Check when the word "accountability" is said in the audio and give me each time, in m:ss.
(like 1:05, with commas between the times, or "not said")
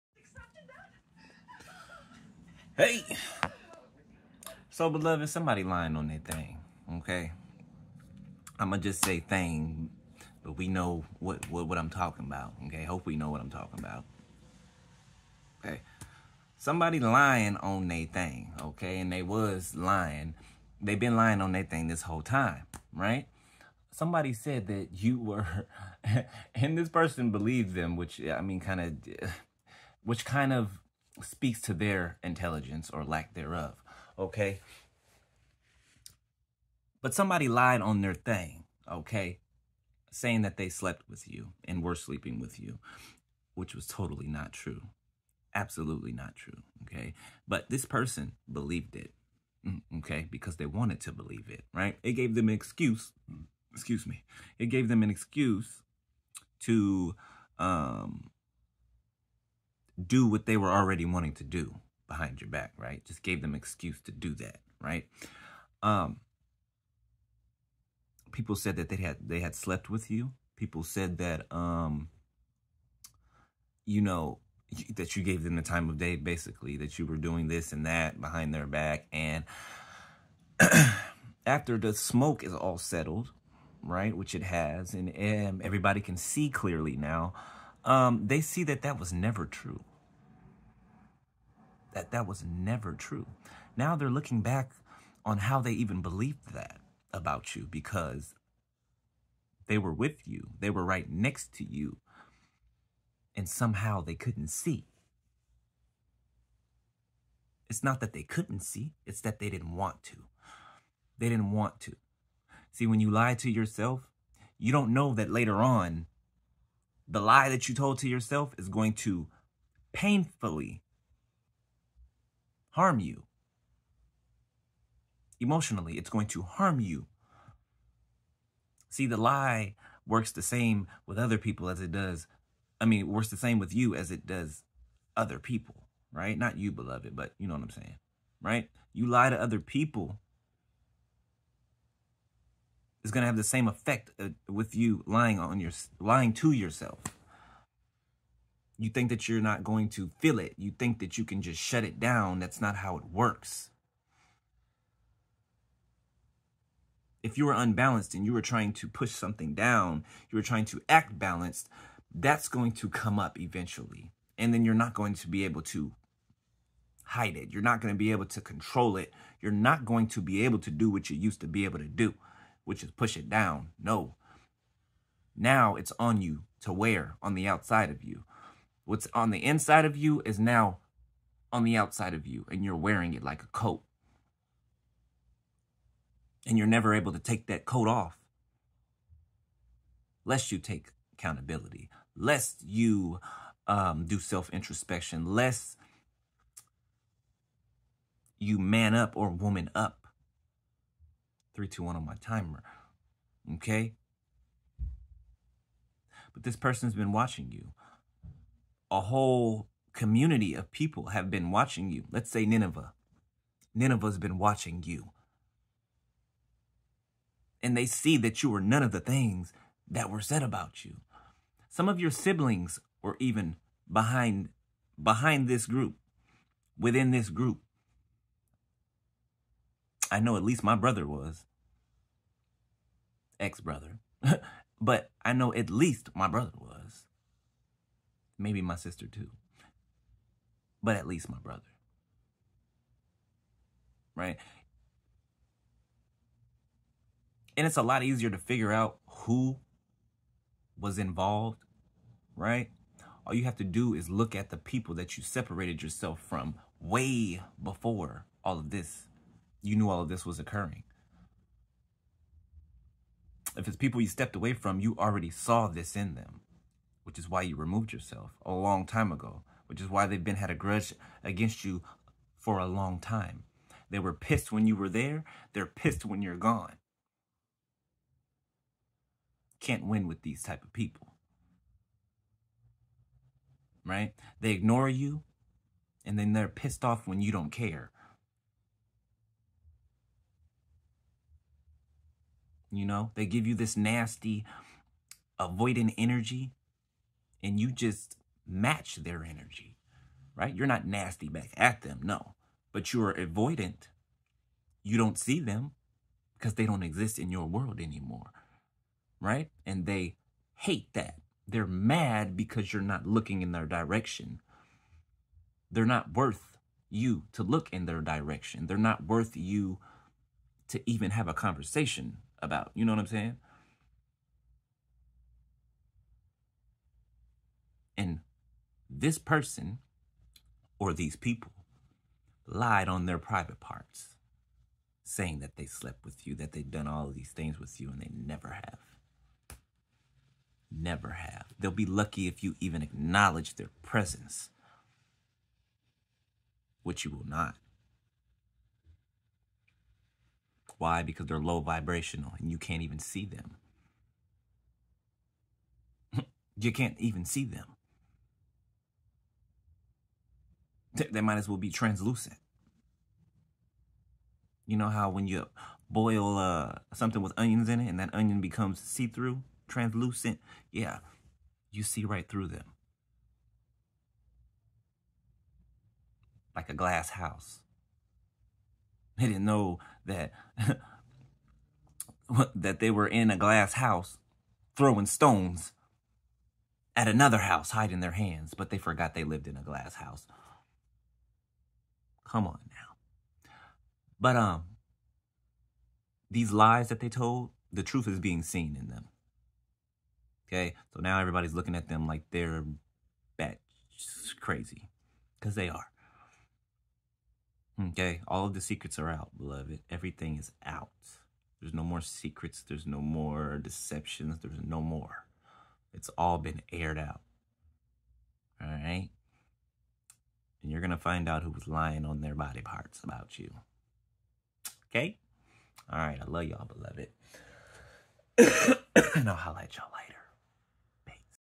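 3:11.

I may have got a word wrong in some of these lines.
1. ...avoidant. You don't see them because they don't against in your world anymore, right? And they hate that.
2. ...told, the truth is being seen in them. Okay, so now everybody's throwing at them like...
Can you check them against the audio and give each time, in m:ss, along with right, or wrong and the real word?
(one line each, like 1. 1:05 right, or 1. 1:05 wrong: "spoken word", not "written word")
1. 5:03 wrong: "exist", not "against"
2. 6:37 wrong: "looking", not "throwing".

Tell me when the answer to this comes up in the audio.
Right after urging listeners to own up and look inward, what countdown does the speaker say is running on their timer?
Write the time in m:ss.
3:21.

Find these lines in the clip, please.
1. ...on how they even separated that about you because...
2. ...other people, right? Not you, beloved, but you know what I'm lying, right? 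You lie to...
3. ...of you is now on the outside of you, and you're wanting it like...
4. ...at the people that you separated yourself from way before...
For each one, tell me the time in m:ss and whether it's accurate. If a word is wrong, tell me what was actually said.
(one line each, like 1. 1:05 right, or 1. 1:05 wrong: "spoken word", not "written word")
1. 1:35 wrong: "believed", not "separated"
2. 2:15 wrong: "saying", not "lying"
3. 2:59 wrong: "wearing", not "wanting"
4. 4:14 right.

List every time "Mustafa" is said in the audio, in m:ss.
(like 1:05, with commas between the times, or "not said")
not said.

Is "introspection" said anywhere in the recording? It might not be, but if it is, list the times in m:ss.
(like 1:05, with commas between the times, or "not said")
3:14.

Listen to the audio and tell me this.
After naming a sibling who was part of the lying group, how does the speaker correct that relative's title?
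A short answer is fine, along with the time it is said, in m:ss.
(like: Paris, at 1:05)
Ex-brother, at 3:53.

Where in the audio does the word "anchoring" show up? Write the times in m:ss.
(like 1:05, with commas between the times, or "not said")
not said.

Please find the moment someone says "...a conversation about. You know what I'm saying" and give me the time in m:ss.
5:21.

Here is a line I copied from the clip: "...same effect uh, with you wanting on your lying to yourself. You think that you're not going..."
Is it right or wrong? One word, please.
wrong.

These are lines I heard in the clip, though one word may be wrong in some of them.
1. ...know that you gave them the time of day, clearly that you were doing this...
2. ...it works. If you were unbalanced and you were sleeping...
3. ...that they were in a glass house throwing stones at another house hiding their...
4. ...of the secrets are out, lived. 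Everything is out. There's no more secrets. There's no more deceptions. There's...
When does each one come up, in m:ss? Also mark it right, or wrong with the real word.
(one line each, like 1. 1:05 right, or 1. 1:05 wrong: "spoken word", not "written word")
1. 1:14 wrong: "basically", not "clearly"
2. 2:32 wrong: "trying", not "sleeping"
3. 6:22 right
4. 6:48 wrong: "beloved", not "lived".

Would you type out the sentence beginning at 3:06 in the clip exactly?
And you're never able to take that coat off.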